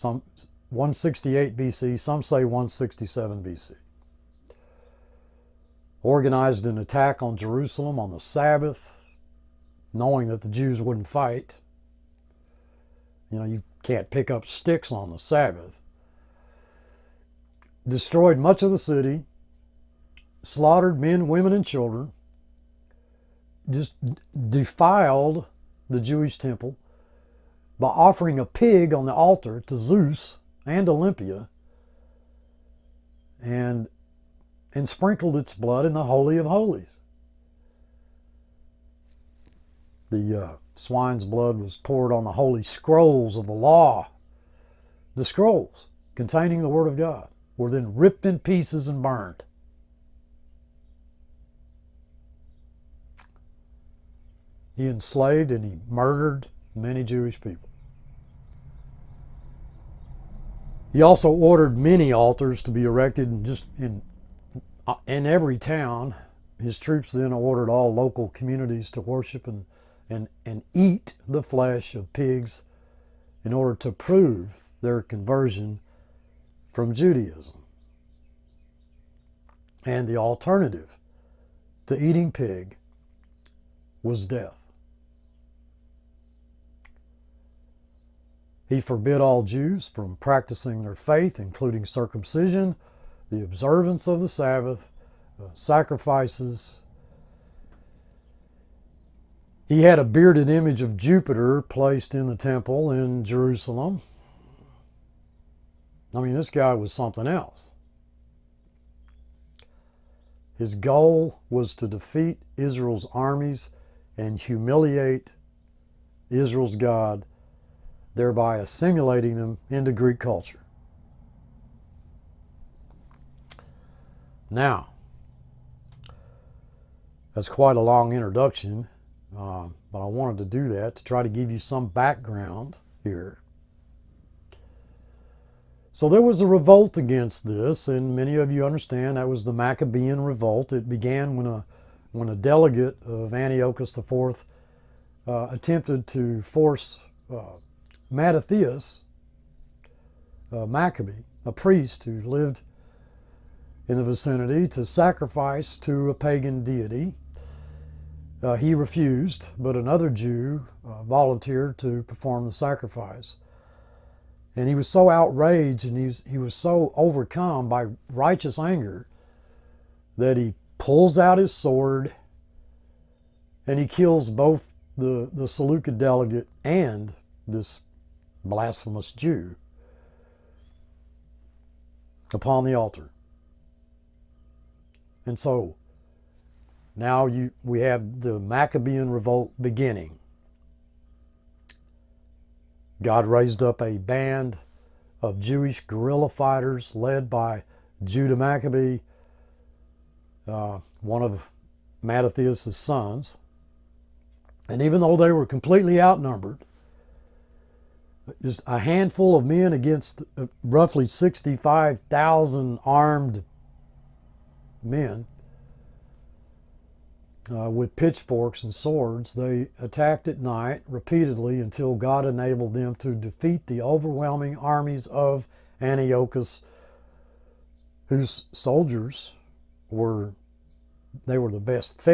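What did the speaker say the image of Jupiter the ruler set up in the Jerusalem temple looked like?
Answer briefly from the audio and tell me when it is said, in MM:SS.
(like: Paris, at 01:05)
Bearded image, at 01:40.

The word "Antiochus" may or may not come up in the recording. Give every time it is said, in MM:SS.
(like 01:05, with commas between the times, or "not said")
02:23, 03:45.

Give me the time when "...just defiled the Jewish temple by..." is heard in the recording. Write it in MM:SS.
00:23.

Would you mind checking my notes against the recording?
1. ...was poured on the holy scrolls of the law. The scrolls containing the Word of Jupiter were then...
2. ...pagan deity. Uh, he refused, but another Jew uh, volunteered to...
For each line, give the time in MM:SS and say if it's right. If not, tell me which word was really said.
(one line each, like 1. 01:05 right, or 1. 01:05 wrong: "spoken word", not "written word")
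1. 00:41 wrong: "God", not "Jupiter"
2. 02:36 right.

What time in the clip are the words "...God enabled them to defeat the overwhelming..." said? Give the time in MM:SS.
03:41.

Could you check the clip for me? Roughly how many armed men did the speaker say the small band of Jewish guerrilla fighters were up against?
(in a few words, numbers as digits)
65,000.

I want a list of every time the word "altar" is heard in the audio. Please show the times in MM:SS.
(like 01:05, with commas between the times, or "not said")
00:29, 01:02, 03:02.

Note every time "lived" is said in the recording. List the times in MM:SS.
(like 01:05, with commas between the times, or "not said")
02:32.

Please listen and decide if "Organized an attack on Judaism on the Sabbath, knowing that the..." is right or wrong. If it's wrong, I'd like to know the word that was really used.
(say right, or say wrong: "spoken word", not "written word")
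wrong: "Jerusalem", not "Judaism".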